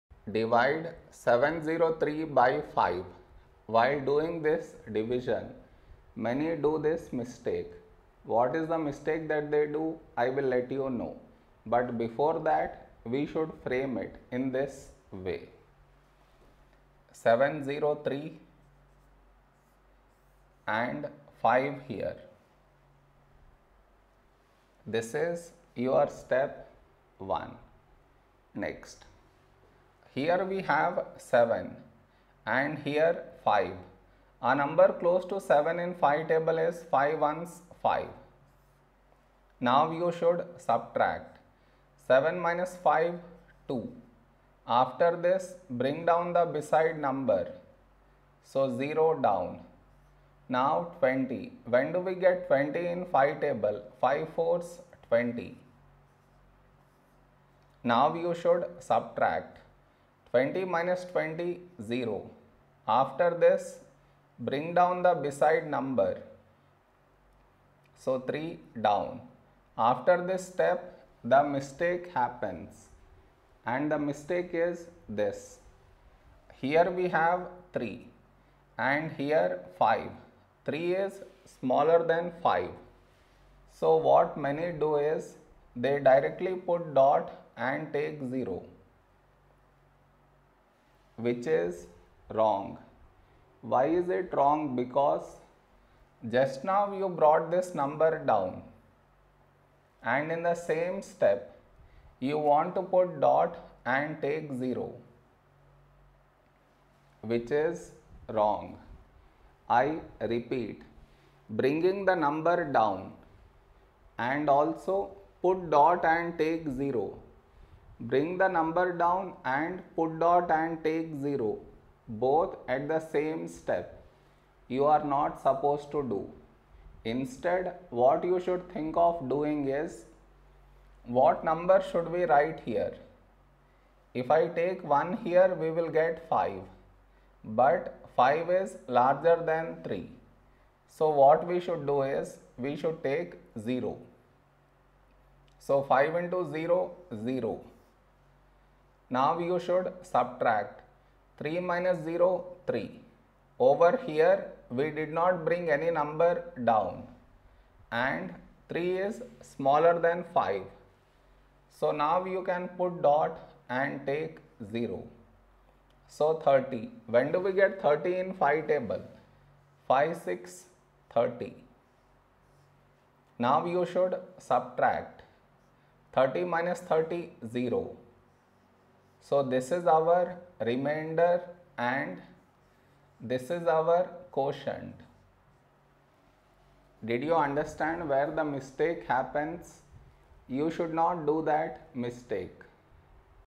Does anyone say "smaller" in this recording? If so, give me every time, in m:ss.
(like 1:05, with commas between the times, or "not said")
1:21, 2:39.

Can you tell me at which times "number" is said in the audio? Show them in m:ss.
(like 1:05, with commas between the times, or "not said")
0:34, 0:46, 1:05, 1:37, 1:52, 1:58, 2:11, 2:35.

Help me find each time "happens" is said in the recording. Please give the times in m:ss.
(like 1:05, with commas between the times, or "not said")
1:12, 3:09.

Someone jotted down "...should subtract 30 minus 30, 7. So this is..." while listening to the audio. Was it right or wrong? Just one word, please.
wrong.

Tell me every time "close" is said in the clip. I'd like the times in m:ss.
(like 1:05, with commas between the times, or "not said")
0:35.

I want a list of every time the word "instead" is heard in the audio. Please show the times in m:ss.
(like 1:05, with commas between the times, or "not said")
2:07.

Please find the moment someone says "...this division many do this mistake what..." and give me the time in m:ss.
0:04.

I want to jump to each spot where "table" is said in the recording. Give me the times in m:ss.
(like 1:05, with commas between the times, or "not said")
0:36, 0:53, 2:48.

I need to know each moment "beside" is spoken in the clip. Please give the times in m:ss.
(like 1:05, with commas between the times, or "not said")
0:46, 1:05.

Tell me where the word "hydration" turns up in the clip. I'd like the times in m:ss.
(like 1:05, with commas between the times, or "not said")
not said.